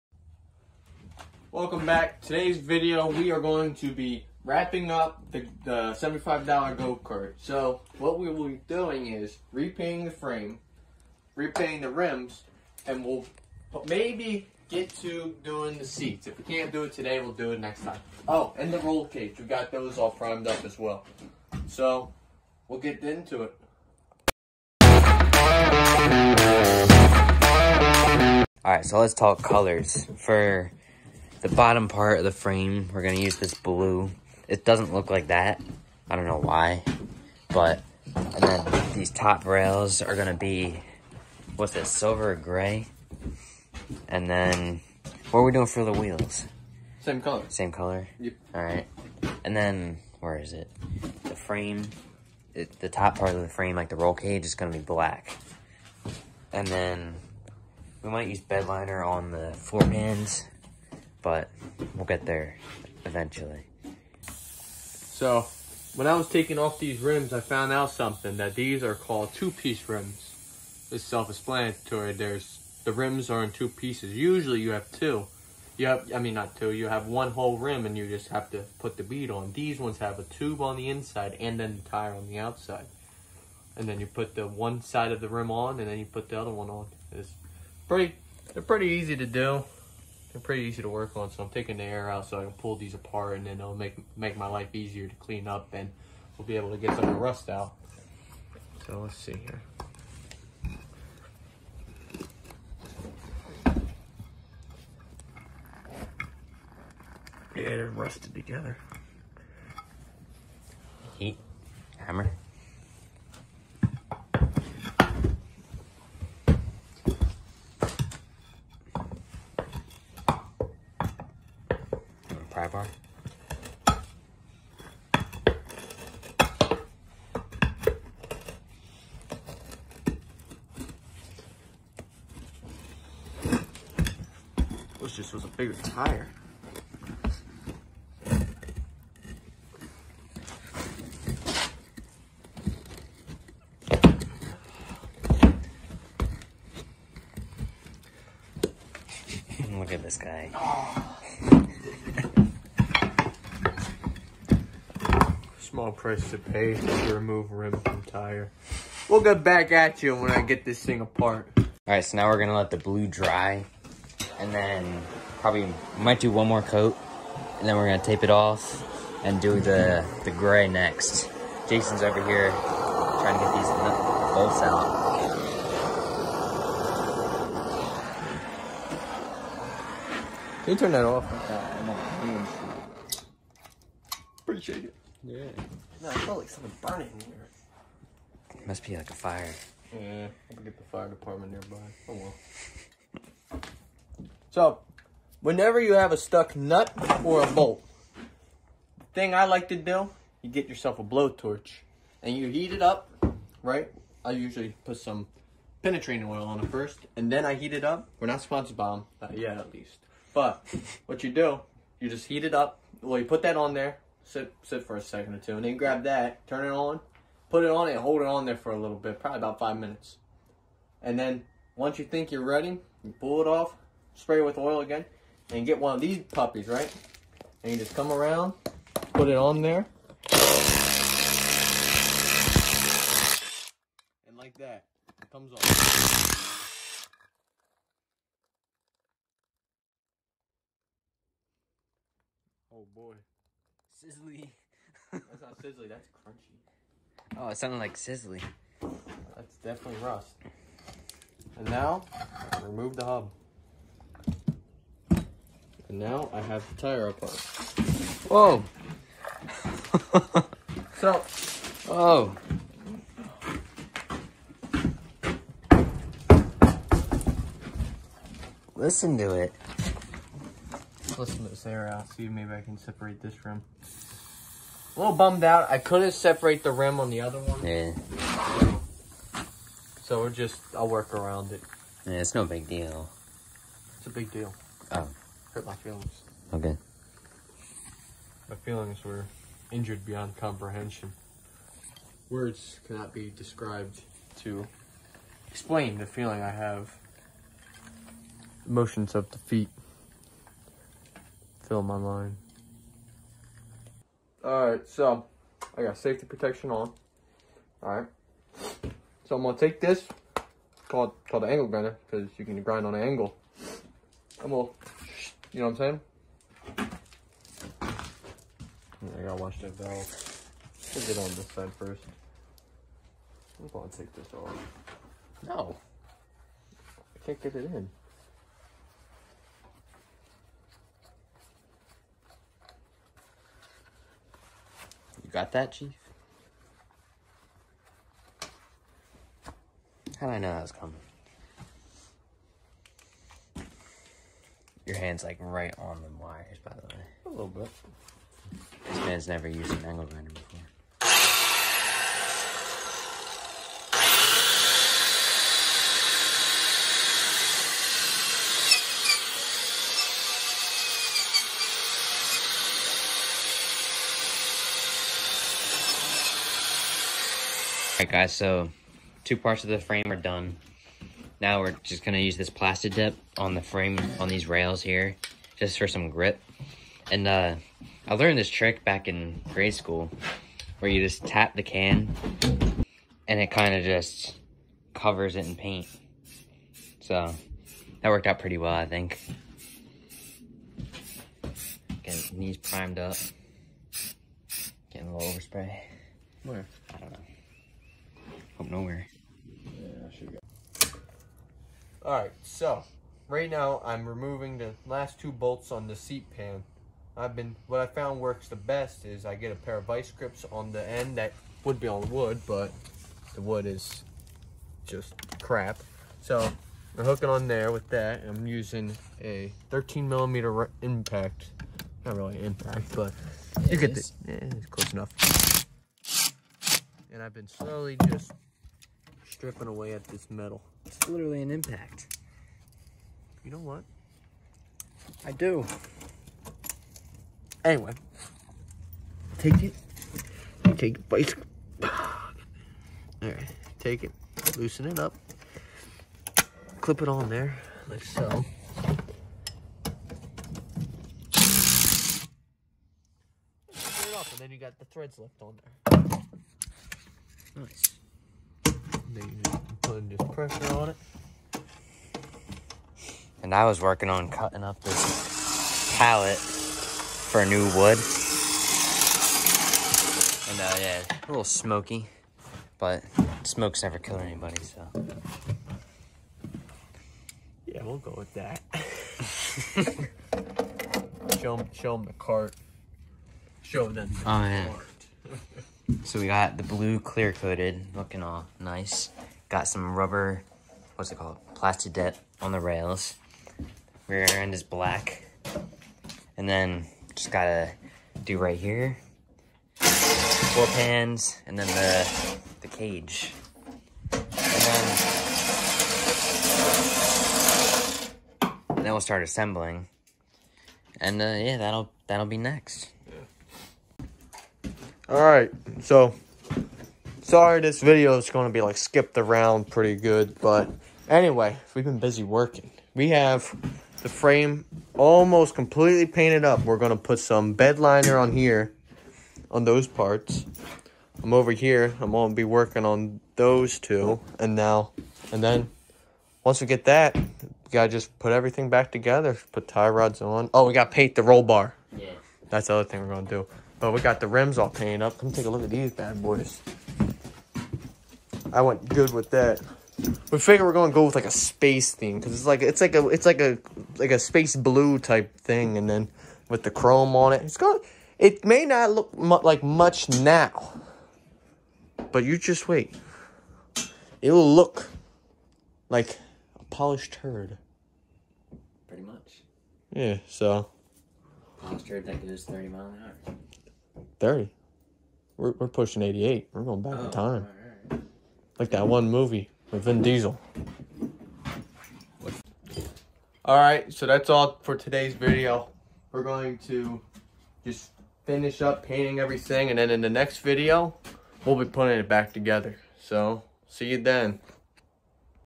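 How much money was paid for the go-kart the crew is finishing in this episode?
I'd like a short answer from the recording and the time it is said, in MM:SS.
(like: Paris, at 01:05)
$75, at 00:05.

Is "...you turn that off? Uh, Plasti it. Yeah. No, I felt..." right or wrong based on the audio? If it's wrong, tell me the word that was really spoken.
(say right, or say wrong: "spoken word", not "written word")
wrong: "Appreciate", not "Plasti".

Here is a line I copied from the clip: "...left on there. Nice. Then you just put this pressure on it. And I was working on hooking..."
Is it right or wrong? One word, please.
wrong.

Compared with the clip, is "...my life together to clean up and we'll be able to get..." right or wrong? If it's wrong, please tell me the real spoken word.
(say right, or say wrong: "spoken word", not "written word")
wrong: "easier", not "together".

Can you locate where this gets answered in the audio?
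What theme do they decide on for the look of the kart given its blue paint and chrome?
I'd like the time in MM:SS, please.
09:11.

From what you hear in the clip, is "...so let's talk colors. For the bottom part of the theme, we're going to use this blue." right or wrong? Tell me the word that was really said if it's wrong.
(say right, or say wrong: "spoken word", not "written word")
wrong: "frame", not "theme".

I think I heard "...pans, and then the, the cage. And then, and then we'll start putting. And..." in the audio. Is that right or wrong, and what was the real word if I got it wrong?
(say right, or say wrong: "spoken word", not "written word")
wrong: "assembling", not "putting".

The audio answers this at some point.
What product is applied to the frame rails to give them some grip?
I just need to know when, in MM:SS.
08:11.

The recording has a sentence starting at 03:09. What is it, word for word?
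Yeah, I'm get the fire department nearby.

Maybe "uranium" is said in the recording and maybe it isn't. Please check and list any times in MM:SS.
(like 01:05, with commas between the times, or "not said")
not said.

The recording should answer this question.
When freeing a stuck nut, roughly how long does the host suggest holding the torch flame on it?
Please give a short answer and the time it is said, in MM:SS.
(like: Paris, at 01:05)
5 minutes, at 03:39.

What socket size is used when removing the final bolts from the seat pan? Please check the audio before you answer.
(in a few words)
13 millimeter.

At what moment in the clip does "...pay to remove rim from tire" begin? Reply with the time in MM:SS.
02:36.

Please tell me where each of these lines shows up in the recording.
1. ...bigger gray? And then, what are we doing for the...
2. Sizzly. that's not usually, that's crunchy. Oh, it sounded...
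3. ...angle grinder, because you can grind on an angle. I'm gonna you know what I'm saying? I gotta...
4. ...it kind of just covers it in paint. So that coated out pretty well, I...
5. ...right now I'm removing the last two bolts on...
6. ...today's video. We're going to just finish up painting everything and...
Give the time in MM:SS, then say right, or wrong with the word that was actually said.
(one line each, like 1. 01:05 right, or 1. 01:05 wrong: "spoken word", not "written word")
1. 00:41 wrong: "silver", not "bigger"
2. 04:04 wrong: "sizzly", not "usually"
3. 05:11 right
4. 06:23 wrong: "worked", not "coated"
5. 06:43 right
6. 09:44 right.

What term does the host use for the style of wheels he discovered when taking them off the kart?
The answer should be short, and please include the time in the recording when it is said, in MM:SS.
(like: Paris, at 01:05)
Two-piece rims, at 01:09.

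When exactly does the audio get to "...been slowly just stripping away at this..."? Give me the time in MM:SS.
07:07.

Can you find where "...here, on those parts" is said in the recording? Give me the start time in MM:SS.
08:48.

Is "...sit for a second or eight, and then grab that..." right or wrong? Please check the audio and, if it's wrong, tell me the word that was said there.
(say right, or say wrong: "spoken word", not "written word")
wrong: "two", not "eight".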